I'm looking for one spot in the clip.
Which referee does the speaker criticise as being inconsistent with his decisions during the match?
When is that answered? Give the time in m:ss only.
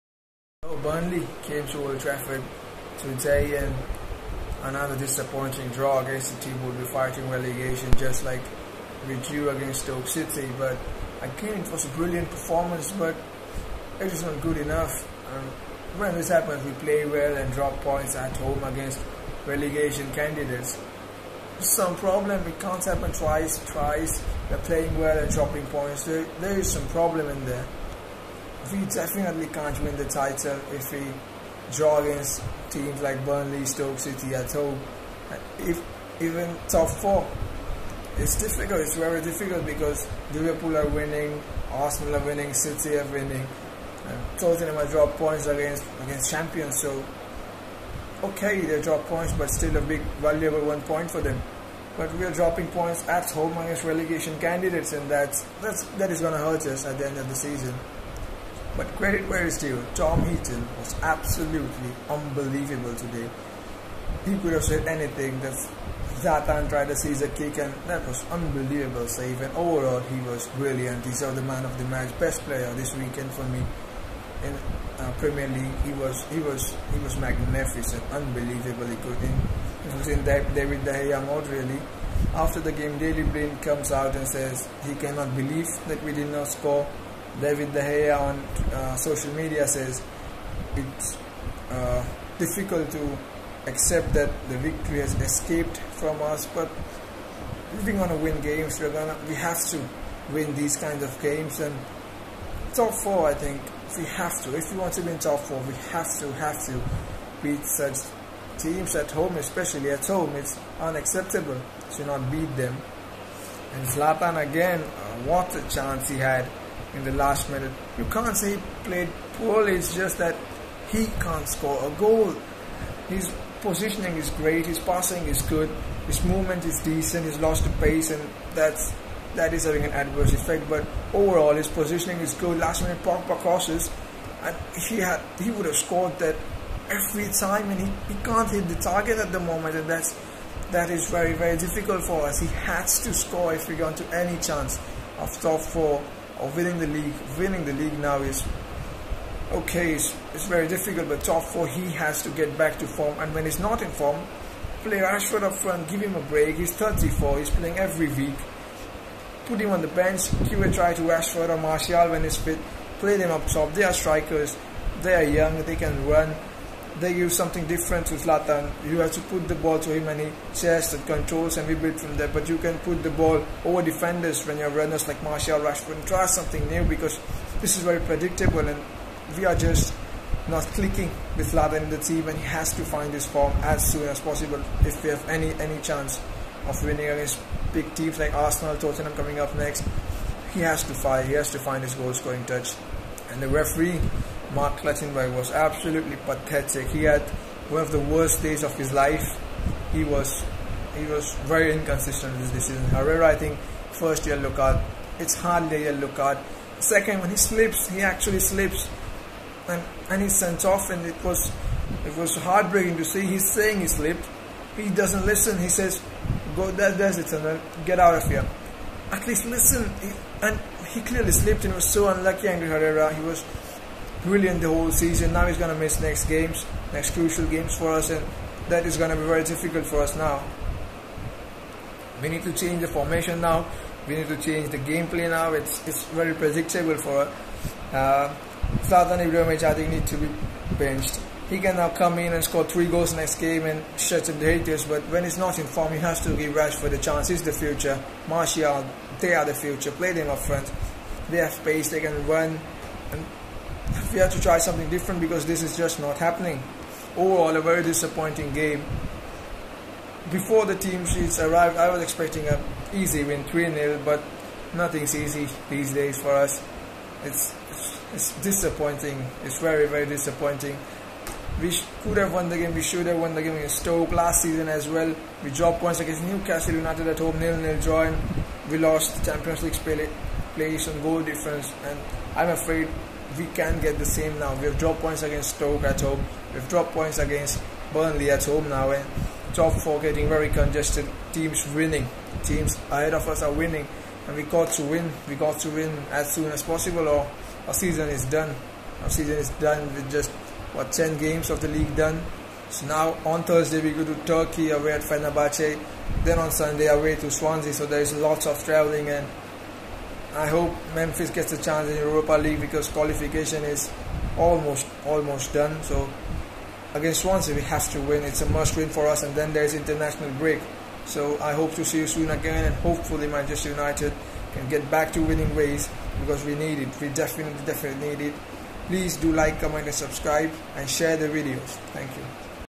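3:14.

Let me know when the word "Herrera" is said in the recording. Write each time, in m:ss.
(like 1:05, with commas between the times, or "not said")
3:22, 3:42.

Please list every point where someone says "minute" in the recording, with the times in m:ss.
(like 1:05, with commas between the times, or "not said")
1:57, 2:12.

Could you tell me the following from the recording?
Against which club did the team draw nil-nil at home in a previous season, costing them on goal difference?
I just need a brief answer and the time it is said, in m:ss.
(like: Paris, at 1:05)
Newcastle United, at 4:36.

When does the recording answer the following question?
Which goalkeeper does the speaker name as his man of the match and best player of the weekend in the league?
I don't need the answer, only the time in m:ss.
0:59.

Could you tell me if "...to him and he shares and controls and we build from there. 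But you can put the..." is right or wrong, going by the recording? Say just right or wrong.
right.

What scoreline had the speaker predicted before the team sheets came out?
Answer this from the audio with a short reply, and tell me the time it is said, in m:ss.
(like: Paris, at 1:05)
3-0, at 4:23.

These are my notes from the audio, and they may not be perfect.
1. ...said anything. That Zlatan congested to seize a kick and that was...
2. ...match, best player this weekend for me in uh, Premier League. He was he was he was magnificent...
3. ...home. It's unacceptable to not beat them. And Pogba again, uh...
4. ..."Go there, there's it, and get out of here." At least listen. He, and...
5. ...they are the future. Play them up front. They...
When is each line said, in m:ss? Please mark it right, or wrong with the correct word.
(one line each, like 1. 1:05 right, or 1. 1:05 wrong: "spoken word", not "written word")
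1. 1:04 wrong: "tried", not "congested"
2. 1:11 right
3. 1:50 wrong: "Zlatan", not "Pogba"
4. 3:36 right
5. 4:09 right.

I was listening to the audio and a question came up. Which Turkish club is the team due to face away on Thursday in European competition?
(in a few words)
Fenerbahce.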